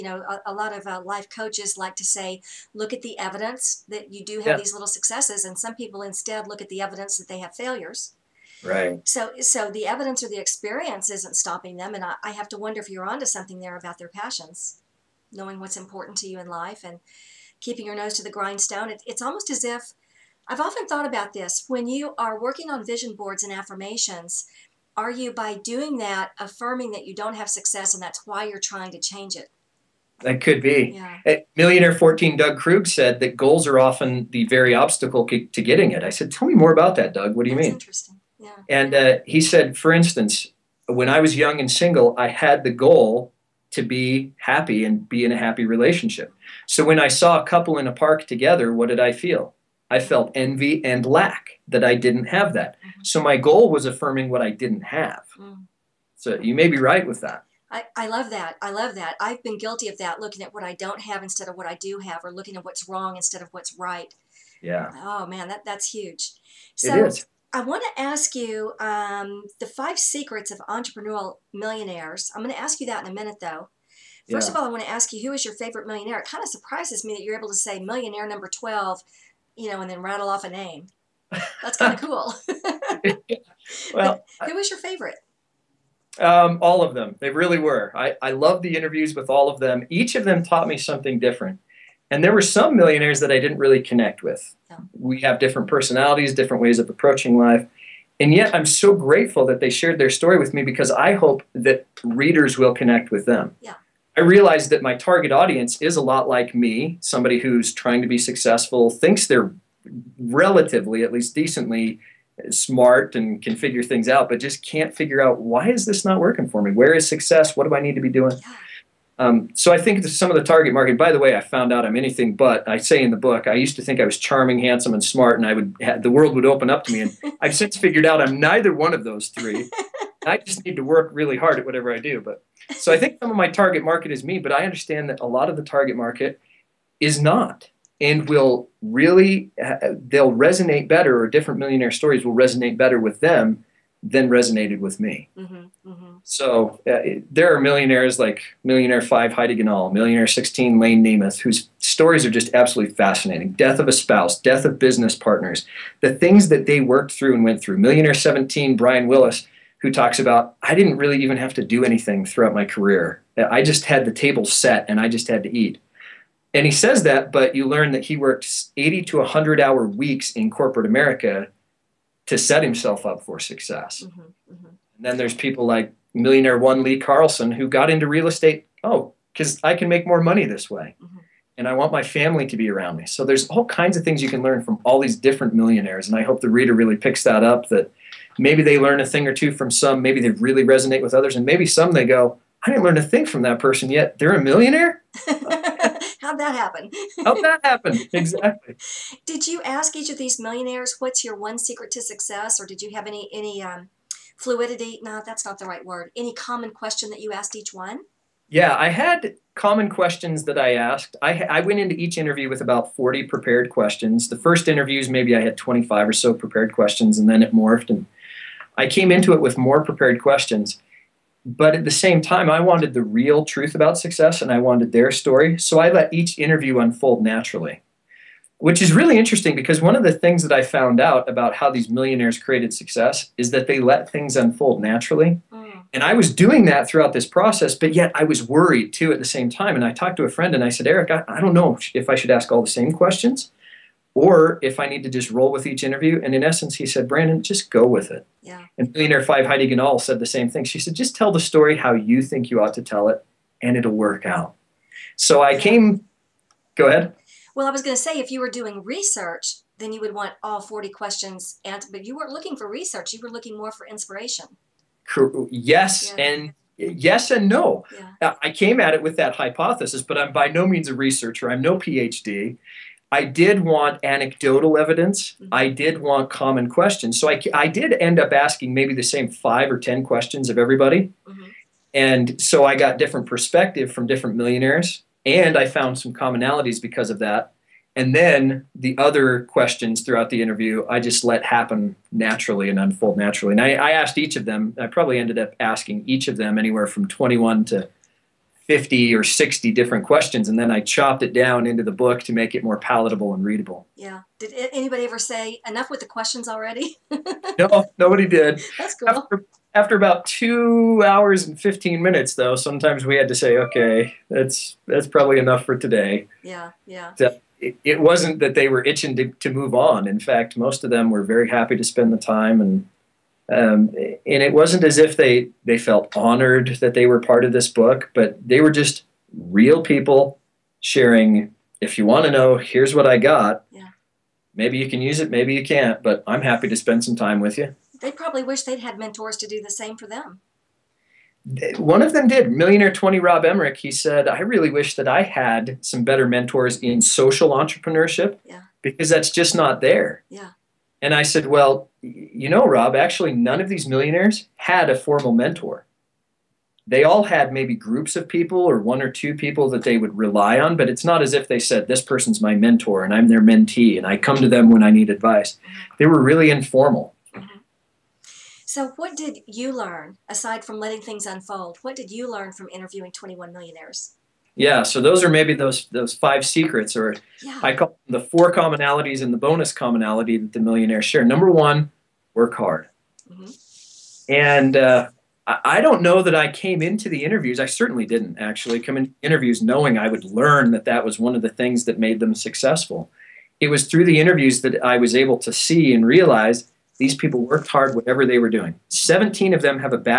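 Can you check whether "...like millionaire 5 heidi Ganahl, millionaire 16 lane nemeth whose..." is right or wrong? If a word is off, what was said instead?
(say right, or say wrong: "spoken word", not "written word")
right.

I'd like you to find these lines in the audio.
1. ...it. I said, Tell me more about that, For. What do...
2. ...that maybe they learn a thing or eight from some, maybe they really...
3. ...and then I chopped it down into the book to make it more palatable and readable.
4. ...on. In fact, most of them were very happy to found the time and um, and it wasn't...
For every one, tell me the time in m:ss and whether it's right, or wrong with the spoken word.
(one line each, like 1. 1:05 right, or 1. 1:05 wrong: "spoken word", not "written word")
1. 0:35 wrong: "Doug", not "For"
2. 3:07 wrong: "two", not "eight"
3. 5:00 right
4. 5:19 wrong: "spend", not "found".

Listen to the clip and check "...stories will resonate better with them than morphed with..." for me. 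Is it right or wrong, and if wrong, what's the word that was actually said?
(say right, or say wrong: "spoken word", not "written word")
wrong: "resonated", not "morphed".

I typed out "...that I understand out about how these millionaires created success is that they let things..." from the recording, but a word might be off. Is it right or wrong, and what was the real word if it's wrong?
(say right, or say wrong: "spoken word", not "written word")
wrong: "found", not "understand".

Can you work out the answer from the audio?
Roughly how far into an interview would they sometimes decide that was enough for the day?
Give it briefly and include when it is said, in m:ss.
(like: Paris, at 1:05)
2 hours and 15 minutes, at 5:10.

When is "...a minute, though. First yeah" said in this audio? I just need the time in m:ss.
1:13.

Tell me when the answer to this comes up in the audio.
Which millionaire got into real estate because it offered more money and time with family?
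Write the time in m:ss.
2:56.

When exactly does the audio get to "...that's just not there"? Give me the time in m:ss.
5:49.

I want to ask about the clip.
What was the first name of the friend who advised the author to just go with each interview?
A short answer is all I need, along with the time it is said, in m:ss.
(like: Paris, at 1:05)
Eric, at 4:00.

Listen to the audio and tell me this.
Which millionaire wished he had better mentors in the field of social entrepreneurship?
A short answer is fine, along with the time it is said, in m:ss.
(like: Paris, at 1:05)
Rob Emmerich, at 5:43.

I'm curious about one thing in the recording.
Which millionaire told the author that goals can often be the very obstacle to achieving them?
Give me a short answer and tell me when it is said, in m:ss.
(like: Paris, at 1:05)
Doug Krug, at 0:32.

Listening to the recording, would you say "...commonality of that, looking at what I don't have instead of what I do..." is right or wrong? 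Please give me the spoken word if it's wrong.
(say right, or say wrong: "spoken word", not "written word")
wrong: "guilty", not "commonality".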